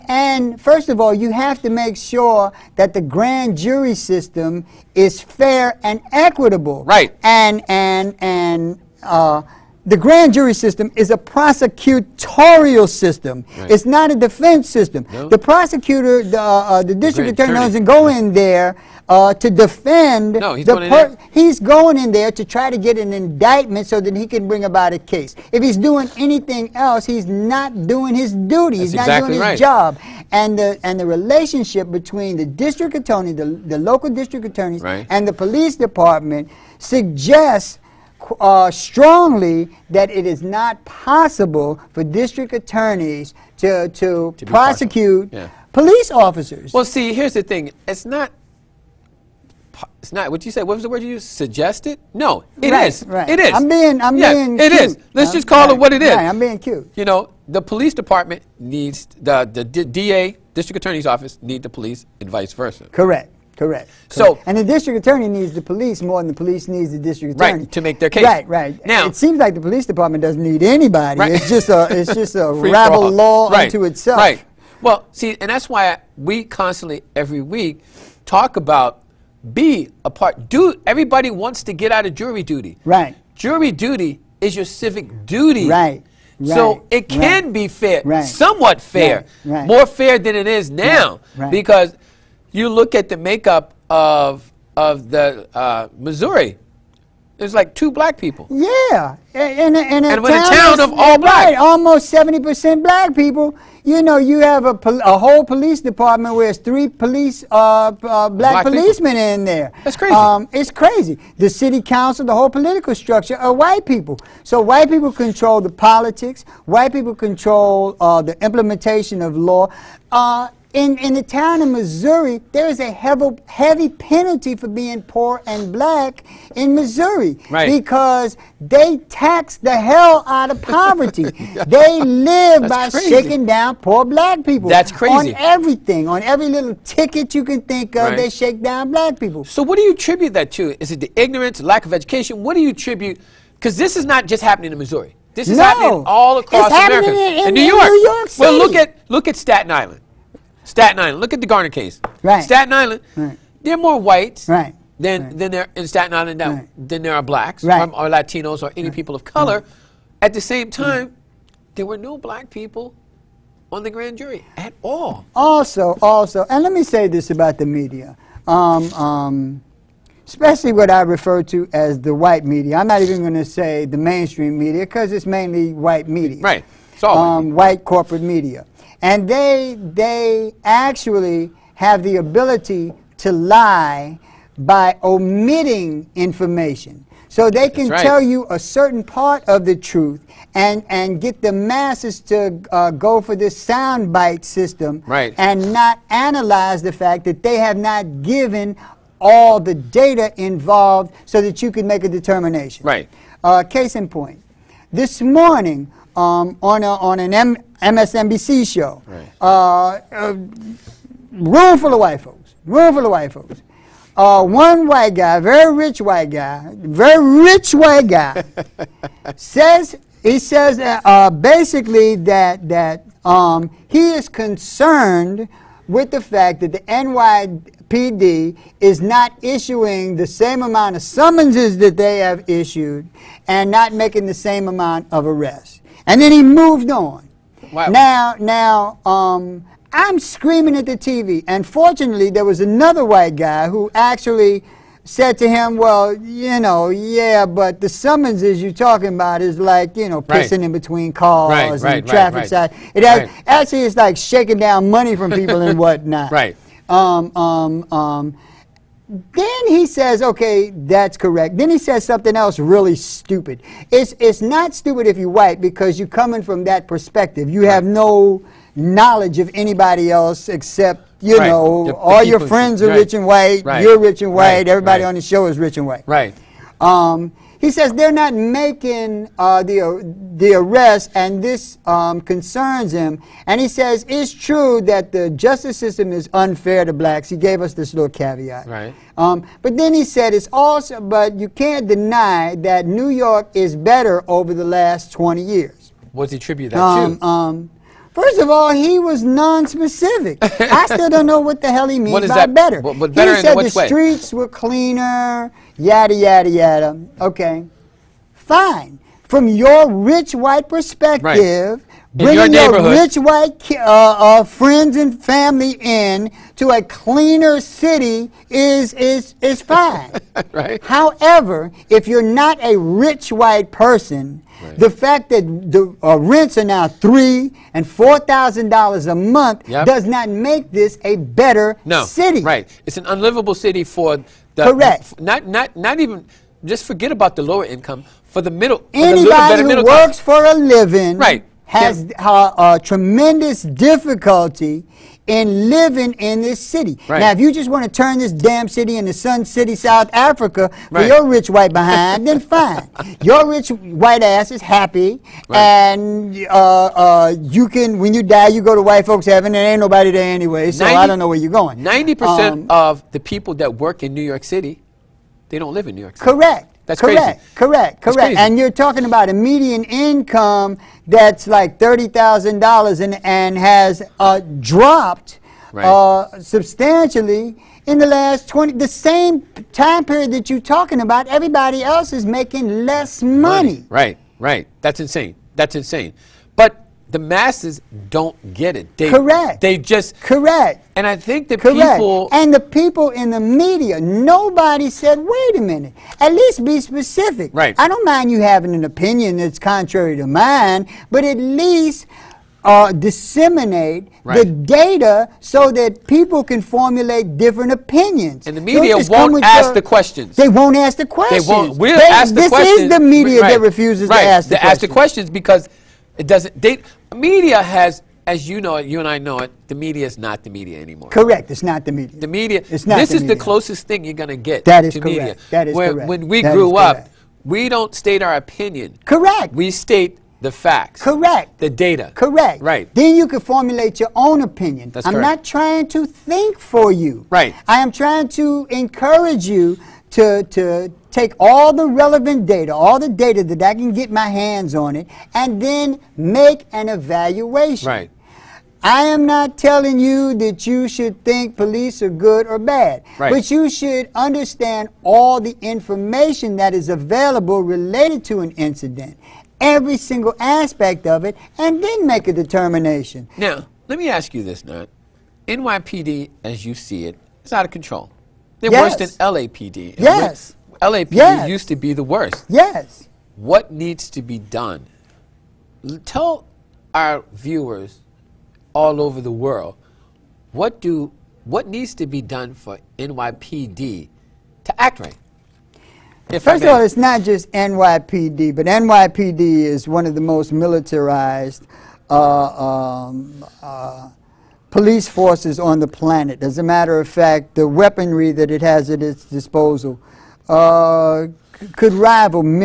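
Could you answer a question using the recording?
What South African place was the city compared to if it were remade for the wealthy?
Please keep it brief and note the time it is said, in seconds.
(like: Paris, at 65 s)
Sun City, at 349 s.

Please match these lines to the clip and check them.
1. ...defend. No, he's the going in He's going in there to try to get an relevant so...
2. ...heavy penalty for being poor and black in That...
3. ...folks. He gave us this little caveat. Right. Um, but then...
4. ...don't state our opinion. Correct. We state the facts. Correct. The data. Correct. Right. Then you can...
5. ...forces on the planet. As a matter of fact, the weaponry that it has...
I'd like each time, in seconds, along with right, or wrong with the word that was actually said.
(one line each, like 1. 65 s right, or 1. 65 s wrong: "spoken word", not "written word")
1. 19 s wrong: "indictment", not "relevant"
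2. 123 s wrong: "Missouri", not "That"
3. 286 s wrong: "blacks", not "folks"
4. 427 s right
5. 495 s right.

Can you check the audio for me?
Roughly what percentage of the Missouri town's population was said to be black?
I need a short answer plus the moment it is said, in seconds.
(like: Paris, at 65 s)
70%, at 102 s.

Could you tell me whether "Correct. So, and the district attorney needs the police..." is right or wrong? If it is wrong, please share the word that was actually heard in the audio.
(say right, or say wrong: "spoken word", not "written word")
right.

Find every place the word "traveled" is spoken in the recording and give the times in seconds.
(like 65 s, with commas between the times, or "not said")
not said.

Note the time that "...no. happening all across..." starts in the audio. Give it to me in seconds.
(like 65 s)
145 s.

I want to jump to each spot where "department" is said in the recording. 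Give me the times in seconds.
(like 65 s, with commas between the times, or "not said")
35 s, 57 s, 69 s, 105 s.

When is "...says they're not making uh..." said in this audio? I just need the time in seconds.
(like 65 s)
277 s.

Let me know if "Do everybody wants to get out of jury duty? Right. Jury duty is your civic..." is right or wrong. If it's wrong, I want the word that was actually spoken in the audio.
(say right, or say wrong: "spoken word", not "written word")
right.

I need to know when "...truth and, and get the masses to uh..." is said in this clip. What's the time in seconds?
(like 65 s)
189 s.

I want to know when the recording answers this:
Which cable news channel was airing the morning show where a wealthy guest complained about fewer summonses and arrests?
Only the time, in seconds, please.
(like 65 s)
207 s.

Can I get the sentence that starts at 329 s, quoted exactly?
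does not make this a better no, city.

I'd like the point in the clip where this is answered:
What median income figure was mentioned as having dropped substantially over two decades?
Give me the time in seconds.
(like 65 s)
371 s.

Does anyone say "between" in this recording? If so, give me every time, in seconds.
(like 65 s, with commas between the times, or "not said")
31 s, 250 s.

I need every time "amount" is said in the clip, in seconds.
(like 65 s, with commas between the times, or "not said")
230 s, 234 s.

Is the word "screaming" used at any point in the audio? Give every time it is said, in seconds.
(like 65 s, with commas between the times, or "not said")
240 s.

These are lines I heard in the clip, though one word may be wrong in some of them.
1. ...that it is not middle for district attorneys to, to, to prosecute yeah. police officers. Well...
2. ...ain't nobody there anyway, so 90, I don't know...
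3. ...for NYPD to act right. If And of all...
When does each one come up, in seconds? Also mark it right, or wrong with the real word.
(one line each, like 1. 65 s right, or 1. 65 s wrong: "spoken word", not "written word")
1. 39 s wrong: "possible", not "middle"
2. 359 s right
3. 482 s wrong: "First", not "And".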